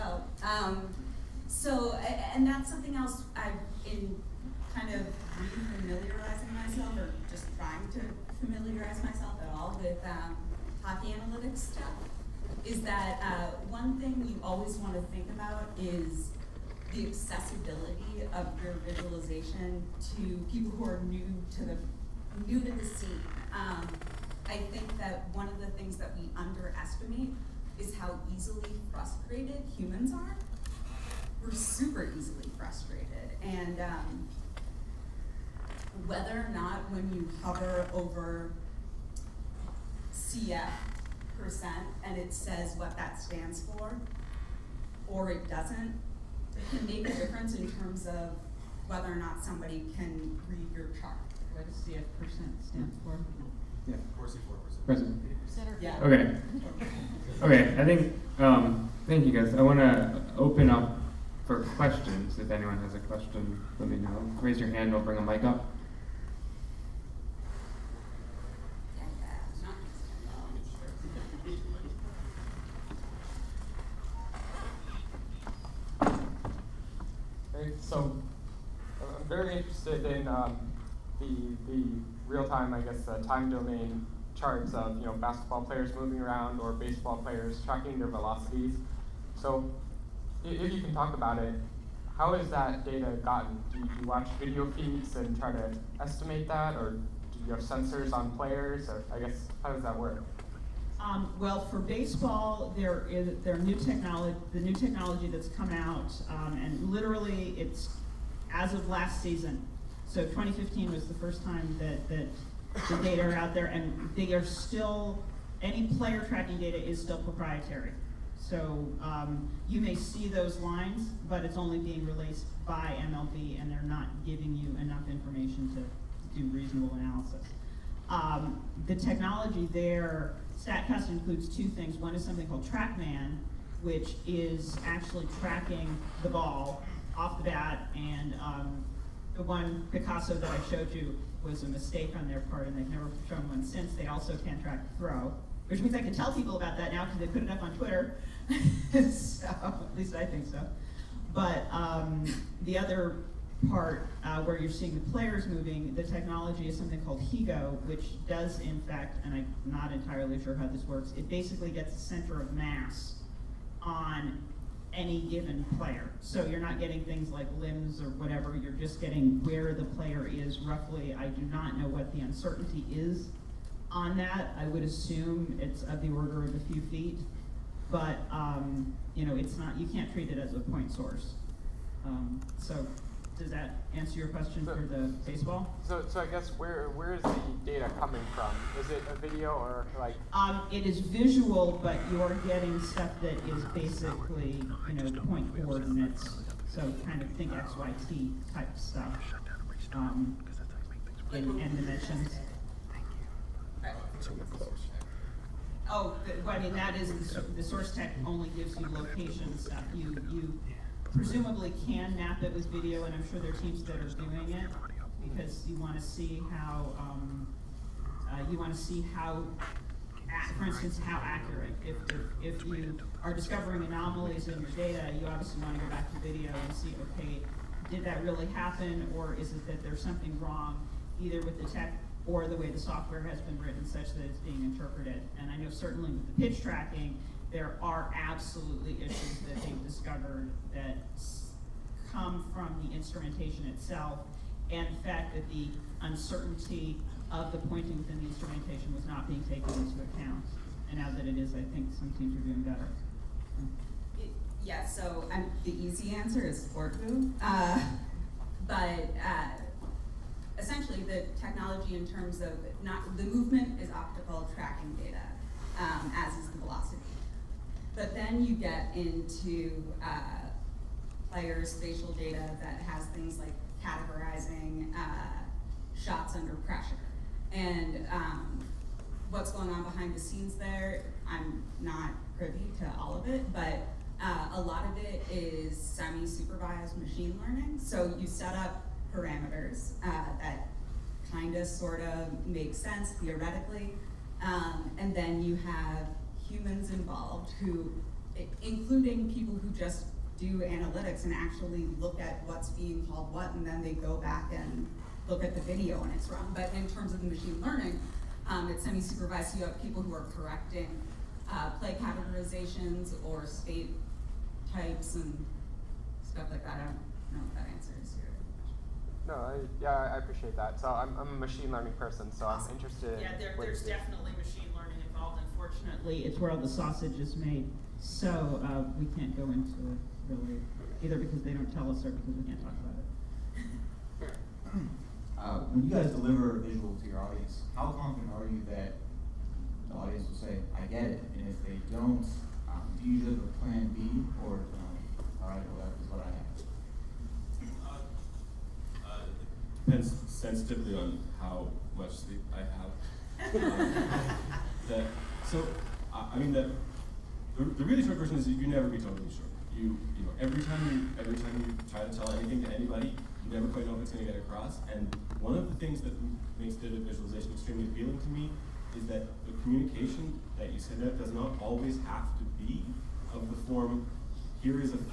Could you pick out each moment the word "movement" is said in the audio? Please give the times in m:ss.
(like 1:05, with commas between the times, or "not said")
4:23.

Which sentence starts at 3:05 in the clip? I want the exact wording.
So, so I guess where where is the data coming from?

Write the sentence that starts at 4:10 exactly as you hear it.
And now that it is, I think some teams are doing better.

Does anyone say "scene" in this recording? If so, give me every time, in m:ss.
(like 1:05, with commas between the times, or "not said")
0:22, 4:40.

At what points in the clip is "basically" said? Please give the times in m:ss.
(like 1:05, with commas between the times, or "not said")
2:41, 3:13.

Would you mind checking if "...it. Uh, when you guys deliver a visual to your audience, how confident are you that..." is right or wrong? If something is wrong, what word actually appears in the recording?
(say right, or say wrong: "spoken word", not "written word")
right.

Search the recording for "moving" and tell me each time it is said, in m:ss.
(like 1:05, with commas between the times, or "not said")
1:25, 2:35.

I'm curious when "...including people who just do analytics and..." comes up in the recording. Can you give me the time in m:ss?
4:58.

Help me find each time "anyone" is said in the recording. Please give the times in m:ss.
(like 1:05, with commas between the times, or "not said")
1:02.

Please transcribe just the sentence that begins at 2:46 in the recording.
So you're not getting things like limbs or whatever, you're just getting where the player is roughly.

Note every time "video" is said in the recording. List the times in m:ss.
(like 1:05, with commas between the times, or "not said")
1:34, 3:09, 3:32, 3:46, 5:05.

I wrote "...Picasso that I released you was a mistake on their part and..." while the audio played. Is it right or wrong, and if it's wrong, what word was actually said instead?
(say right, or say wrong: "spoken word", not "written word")
wrong: "showed", not "released".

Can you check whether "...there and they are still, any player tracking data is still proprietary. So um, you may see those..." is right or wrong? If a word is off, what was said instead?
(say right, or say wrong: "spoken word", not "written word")
right.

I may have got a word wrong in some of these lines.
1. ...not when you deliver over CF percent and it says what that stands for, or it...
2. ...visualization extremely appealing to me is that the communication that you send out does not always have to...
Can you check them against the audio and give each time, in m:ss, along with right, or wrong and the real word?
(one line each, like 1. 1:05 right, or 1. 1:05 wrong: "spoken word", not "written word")
1. 0:36 wrong: "hover", not "deliver"
2. 6:06 right.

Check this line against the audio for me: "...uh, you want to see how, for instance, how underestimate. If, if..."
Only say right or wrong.
wrong.